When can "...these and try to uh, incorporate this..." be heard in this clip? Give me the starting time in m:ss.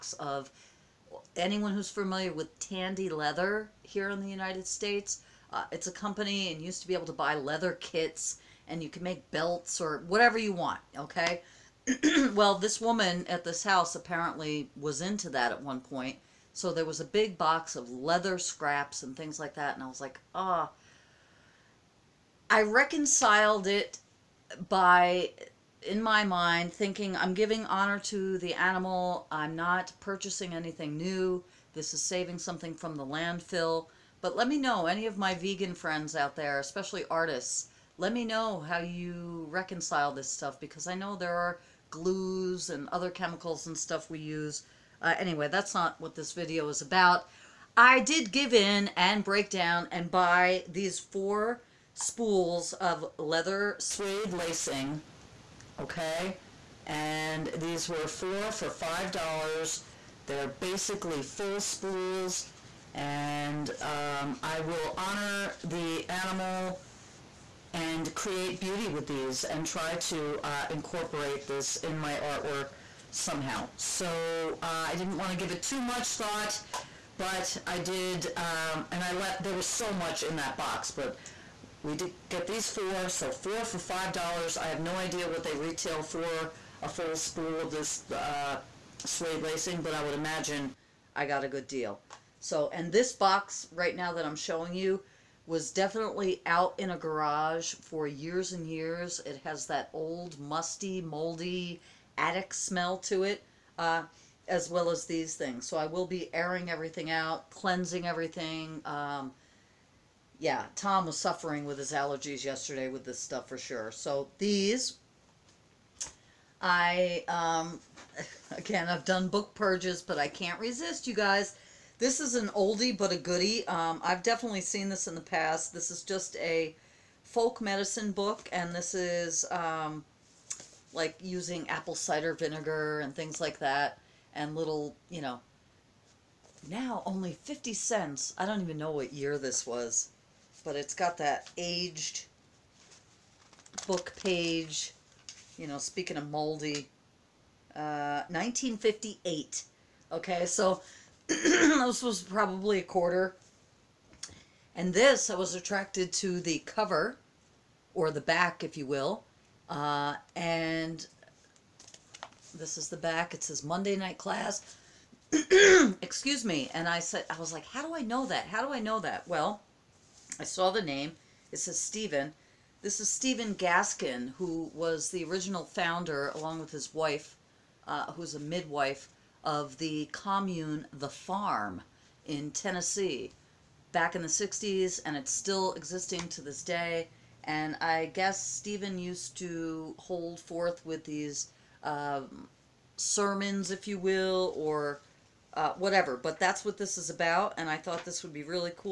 1:09.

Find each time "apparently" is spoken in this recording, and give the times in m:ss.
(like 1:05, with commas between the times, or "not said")
0:13.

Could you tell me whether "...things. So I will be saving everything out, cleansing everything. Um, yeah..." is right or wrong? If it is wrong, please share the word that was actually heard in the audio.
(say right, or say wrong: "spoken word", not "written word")
wrong: "airing", not "saving".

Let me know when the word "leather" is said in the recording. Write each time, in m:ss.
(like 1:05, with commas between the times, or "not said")
0:03, 0:07, 0:17, 0:53.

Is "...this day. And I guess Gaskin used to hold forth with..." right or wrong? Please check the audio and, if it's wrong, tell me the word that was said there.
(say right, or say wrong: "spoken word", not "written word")
wrong: "Stephen", not "Gaskin".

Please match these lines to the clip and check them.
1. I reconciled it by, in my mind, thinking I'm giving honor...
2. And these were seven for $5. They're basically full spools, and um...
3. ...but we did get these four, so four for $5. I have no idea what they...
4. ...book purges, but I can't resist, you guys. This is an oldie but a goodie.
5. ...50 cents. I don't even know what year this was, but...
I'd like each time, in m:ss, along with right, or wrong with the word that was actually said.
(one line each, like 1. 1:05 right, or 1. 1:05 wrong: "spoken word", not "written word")
1. 0:22 right
2. 0:56 wrong: "four", not "seven"
3. 1:20 right
4. 1:59 right
5. 2:17 right.